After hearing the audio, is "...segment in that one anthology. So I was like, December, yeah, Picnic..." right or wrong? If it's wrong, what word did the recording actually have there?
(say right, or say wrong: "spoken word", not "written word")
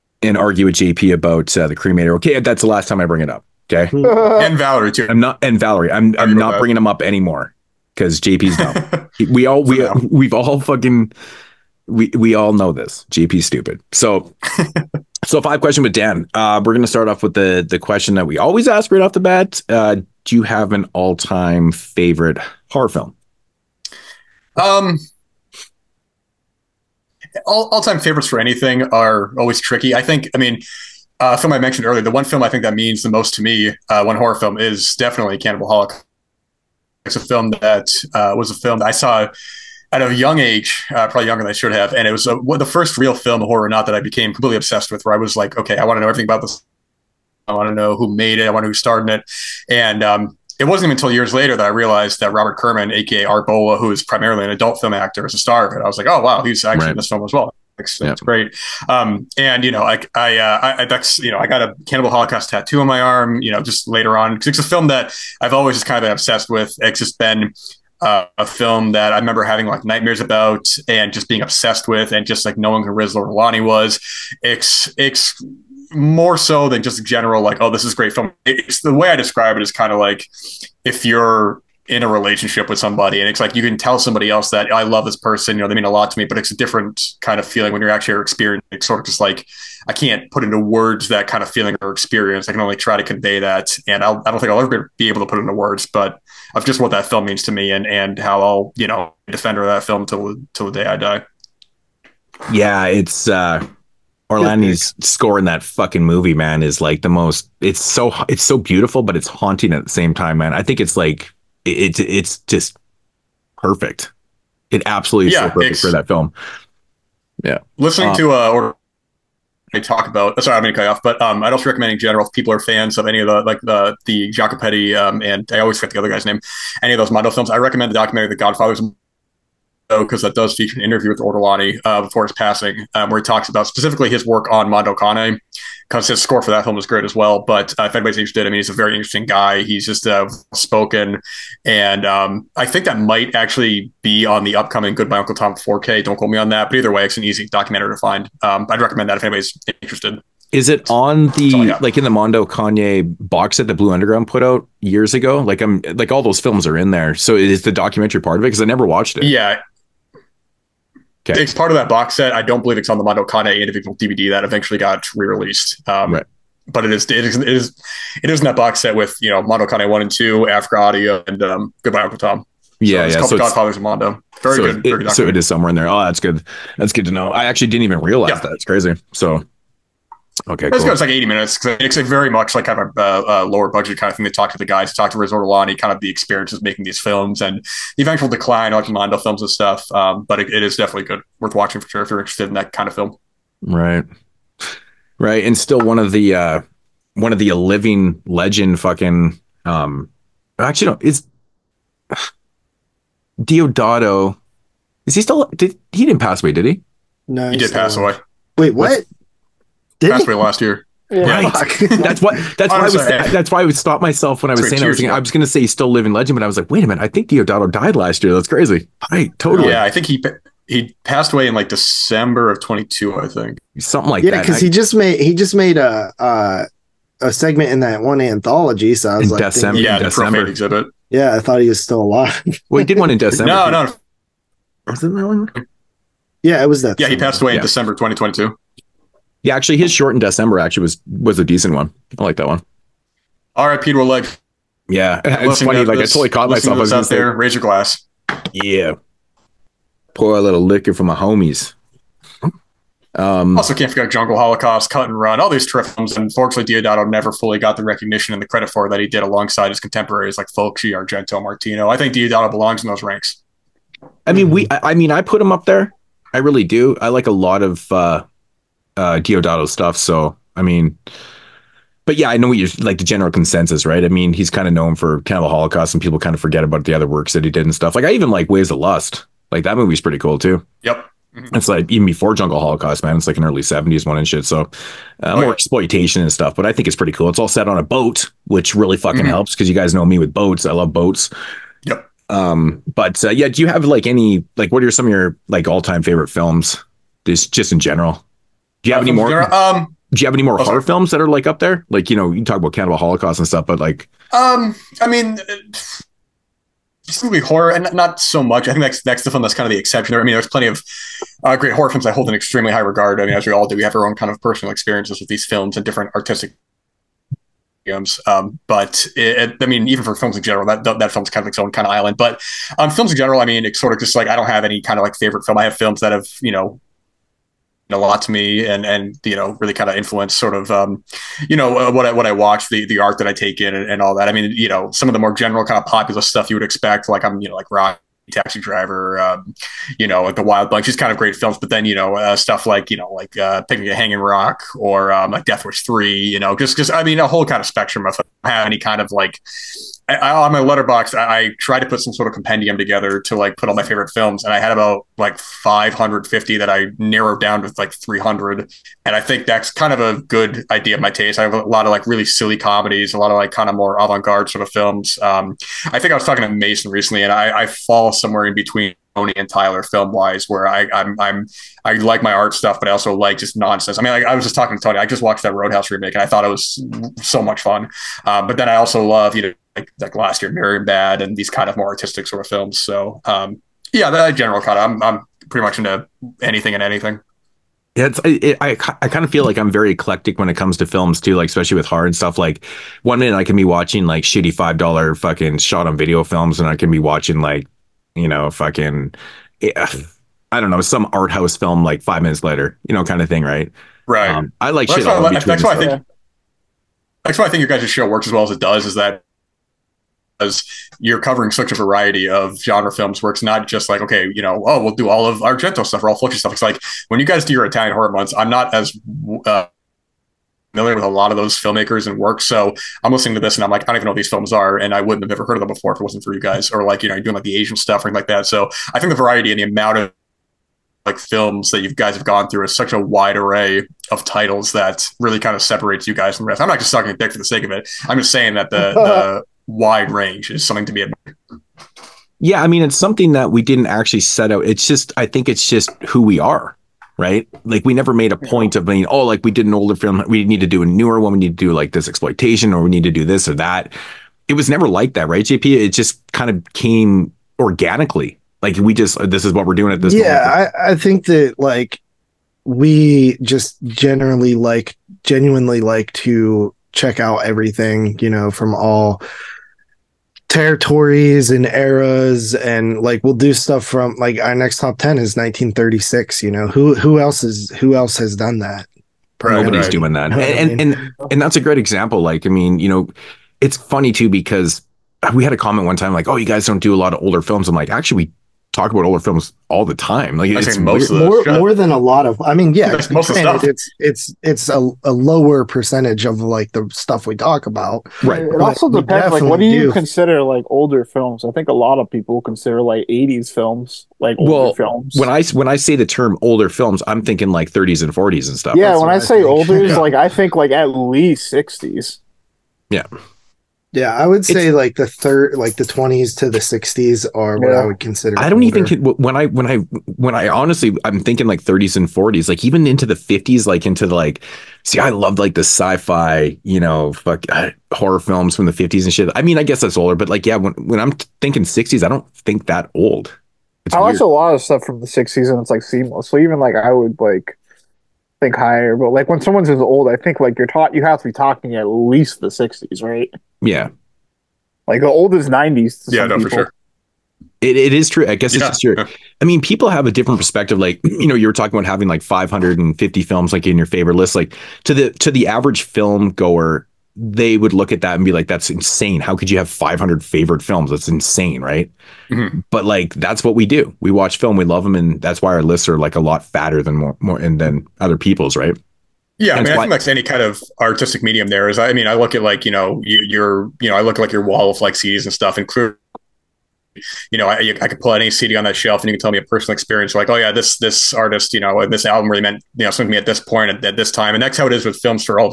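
wrong: "December", not "Picnic".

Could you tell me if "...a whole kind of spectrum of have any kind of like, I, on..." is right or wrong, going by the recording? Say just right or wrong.
right.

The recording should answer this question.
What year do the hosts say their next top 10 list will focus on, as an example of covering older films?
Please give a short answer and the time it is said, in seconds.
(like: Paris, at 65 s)
1936, at 475 s.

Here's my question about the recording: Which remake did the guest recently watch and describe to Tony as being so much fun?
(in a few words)
Roadhouse.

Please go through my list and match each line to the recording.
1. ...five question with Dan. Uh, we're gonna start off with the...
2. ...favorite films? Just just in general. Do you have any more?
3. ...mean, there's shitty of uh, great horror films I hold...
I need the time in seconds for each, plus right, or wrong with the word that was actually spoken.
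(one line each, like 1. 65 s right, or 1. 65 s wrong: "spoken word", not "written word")
1. 15 s right
2. 296 s right
3. 310 s wrong: "plenty", not "shitty".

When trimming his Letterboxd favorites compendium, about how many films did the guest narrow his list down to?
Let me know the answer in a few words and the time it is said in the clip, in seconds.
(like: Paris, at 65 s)
300, at 357 s.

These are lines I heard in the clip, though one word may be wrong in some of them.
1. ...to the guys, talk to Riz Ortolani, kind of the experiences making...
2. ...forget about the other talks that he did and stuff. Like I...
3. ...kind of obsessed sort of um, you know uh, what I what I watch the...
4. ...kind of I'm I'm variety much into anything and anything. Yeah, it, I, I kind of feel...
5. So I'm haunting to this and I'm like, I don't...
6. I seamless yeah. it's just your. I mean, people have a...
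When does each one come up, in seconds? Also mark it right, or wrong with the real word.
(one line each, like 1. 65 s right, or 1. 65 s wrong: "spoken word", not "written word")
1. 184 s right
2. 276 s wrong: "works", not "talks"
3. 329 s wrong: "influenced", not "obsessed"
4. 384 s wrong: "pretty", not "variety"
5. 422 s wrong: "listening", not "haunting"
6. 548 s wrong: "guess", not "seamless".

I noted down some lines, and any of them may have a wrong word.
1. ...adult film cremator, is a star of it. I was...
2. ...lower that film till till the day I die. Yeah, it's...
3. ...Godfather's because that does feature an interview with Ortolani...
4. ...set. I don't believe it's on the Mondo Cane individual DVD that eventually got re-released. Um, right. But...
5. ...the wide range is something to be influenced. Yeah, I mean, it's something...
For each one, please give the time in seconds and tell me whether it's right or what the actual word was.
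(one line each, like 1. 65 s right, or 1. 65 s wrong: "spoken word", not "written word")
1. 54 s wrong: "actor", not "cremator"
2. 99 s wrong: "defender", not "lower"
3. 128 s right
4. 162 s right
5. 439 s wrong: "admired", not "influenced".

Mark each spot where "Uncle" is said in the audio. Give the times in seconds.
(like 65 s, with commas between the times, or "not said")
145 s, 172 s.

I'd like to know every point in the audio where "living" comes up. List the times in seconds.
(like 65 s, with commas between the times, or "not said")
197 s, 215 s.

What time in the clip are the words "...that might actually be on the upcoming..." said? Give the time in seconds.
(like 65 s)
142 s.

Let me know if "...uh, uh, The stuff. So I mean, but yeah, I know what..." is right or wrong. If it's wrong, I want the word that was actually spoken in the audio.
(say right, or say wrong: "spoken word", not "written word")
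wrong: "Deodato", not "The".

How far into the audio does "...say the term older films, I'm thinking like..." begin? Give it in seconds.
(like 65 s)
505 s.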